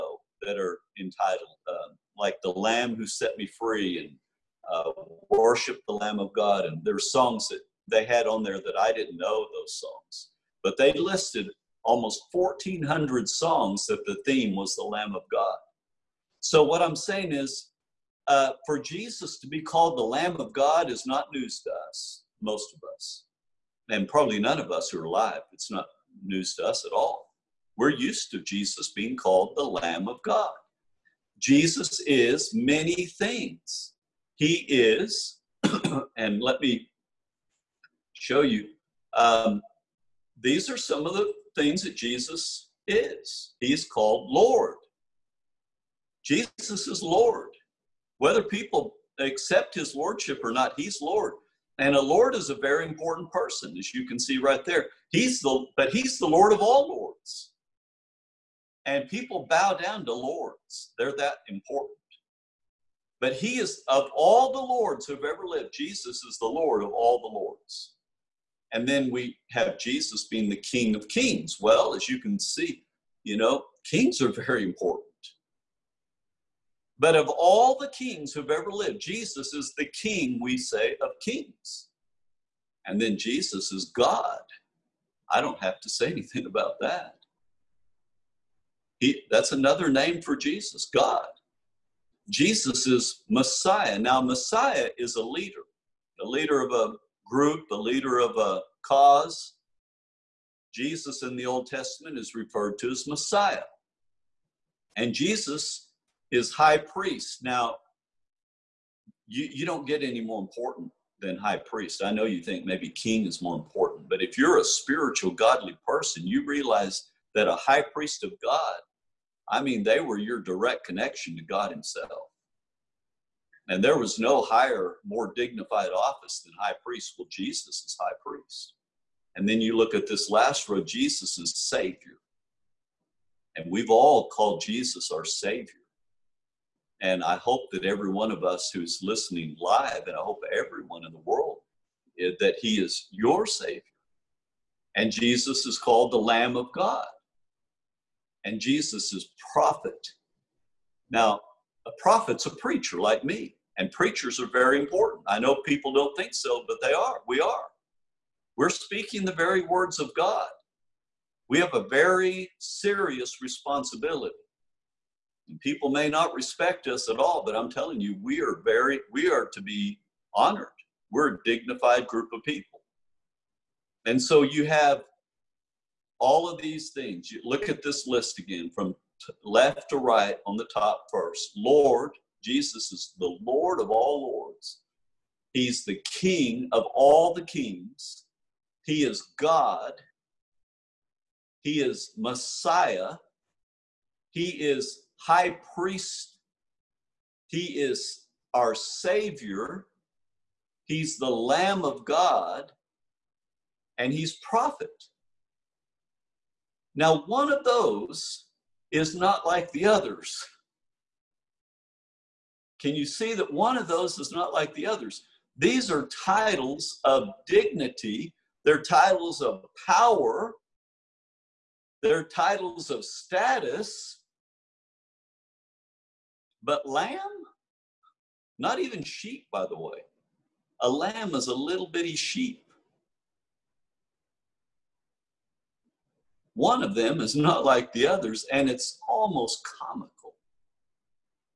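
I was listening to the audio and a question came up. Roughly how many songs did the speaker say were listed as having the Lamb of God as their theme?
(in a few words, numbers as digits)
1,400.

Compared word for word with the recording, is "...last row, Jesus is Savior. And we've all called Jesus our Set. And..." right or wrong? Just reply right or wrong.
wrong.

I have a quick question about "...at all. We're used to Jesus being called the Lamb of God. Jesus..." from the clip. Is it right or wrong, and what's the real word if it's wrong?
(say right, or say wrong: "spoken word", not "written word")
right.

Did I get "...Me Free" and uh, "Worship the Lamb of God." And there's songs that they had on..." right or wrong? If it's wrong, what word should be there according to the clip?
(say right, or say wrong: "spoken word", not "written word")
right.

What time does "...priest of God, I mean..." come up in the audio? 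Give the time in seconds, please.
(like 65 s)
117 s.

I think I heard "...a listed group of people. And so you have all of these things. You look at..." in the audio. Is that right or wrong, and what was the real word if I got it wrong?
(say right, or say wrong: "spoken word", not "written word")
wrong: "dignified", not "listed".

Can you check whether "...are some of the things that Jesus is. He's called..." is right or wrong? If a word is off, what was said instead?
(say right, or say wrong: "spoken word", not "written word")
right.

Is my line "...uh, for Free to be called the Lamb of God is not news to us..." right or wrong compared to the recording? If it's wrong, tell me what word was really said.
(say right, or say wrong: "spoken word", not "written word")
wrong: "Jesus", not "Free".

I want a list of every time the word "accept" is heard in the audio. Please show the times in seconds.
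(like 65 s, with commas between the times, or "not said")
49 s.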